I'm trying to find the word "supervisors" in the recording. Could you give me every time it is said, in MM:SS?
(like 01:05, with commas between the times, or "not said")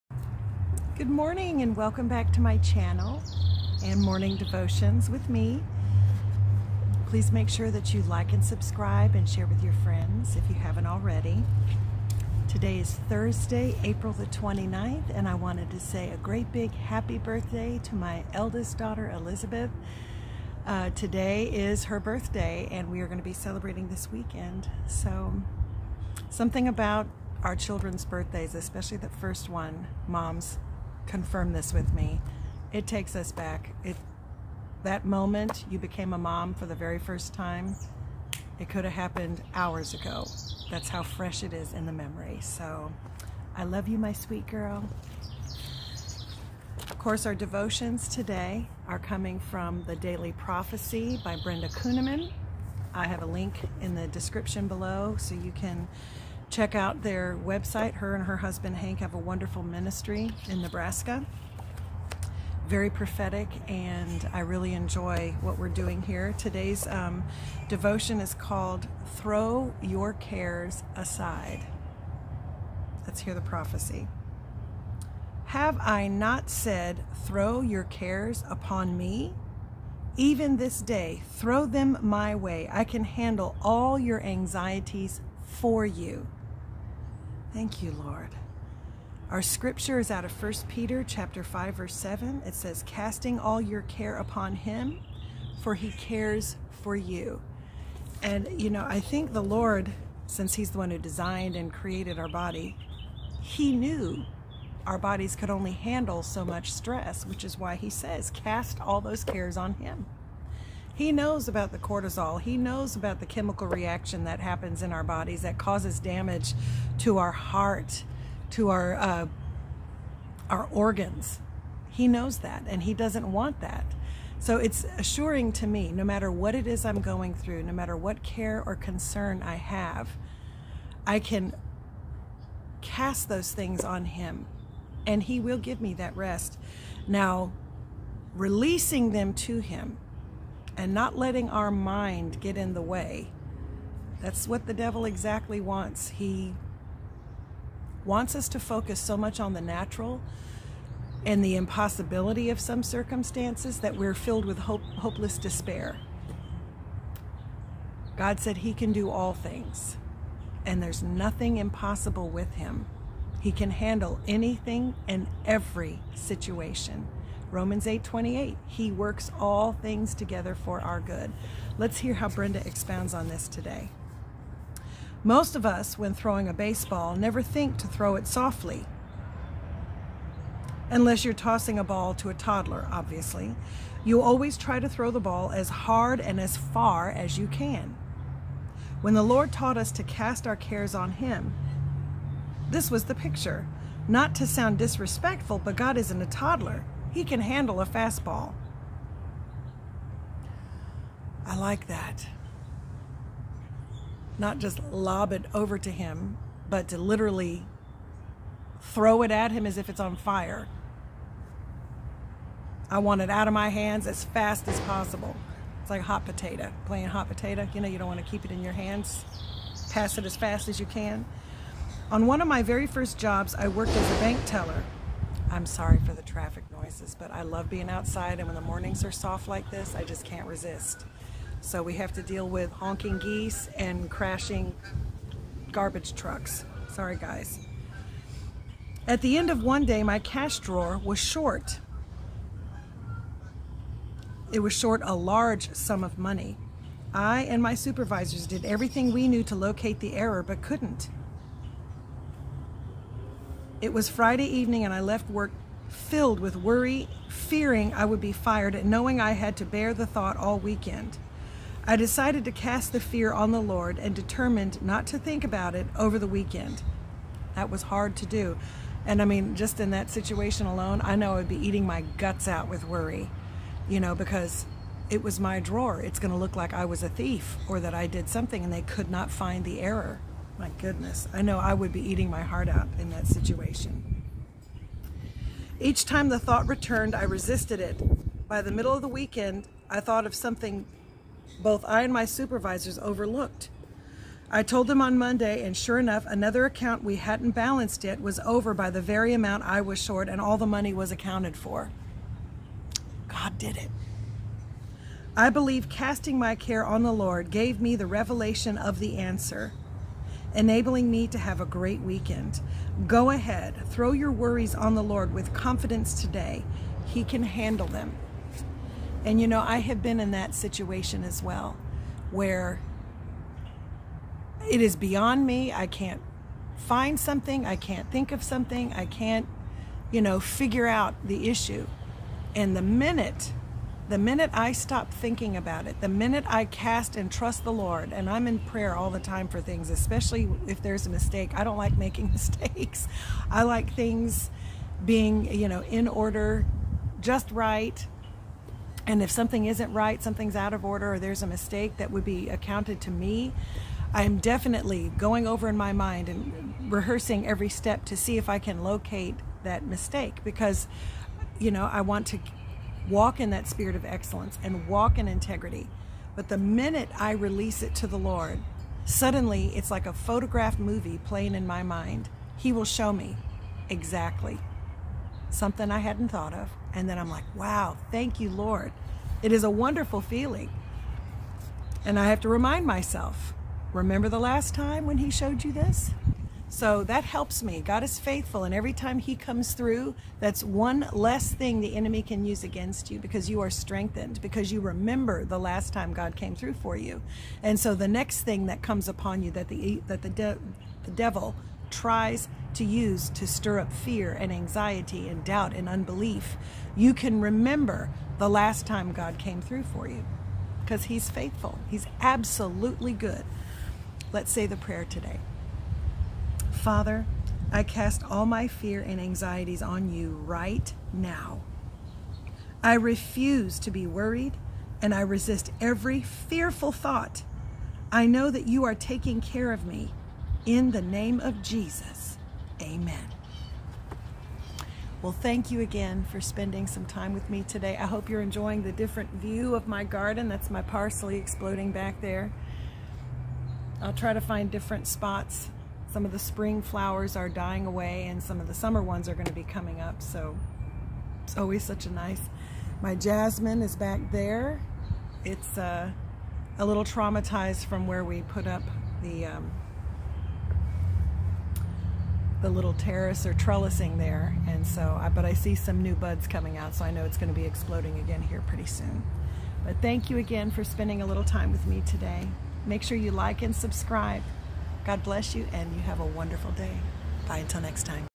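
04:07, 04:52.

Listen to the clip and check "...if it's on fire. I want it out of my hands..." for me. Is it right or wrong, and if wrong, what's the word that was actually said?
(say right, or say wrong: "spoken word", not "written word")
right.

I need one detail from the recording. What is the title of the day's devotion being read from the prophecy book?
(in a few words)
Throw Your Cares Aside.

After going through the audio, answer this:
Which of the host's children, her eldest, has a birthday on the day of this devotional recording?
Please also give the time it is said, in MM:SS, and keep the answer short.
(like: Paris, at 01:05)
Elizabeth, at 00:19.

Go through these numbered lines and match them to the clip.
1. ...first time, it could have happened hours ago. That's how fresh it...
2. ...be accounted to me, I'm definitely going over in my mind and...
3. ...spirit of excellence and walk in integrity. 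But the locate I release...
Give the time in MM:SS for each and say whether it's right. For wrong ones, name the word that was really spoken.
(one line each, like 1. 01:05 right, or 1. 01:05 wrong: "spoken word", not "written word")
1. 00:36 right
2. 05:52 right
3. 06:03 wrong: "minute", not "locate".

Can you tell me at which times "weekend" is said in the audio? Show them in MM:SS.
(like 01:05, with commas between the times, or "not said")
00:24, 04:20, 04:26, 04:49, 05:12.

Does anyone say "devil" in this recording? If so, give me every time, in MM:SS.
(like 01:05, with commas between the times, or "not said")
02:24, 06:41.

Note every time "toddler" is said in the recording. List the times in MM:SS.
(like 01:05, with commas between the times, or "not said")
03:02, 03:16.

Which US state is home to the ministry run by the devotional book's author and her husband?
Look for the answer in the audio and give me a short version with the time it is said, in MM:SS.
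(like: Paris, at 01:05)
Nebraska, at 01:00.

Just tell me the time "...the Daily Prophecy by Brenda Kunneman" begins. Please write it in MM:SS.
00:49.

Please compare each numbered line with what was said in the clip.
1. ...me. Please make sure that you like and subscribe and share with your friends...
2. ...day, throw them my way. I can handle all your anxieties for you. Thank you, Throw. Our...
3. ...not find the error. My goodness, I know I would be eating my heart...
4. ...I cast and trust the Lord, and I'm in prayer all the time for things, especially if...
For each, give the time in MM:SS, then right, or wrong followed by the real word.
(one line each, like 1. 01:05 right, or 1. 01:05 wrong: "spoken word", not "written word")
1. 00:05 right
2. 01:20 wrong: "Lord", not "Throw"
3. 04:39 right
4. 05:36 right.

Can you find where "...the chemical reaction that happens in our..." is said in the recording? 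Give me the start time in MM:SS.
01:53.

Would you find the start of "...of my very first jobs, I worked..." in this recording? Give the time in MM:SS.
03:42.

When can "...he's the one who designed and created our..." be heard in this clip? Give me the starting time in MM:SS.
01:40.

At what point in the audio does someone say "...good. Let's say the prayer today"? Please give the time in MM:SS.
06:53.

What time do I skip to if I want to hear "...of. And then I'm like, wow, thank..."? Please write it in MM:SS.
06:16.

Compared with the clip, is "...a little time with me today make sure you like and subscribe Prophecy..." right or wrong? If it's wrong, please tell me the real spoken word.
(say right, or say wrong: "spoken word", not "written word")
wrong: "God", not "Prophecy".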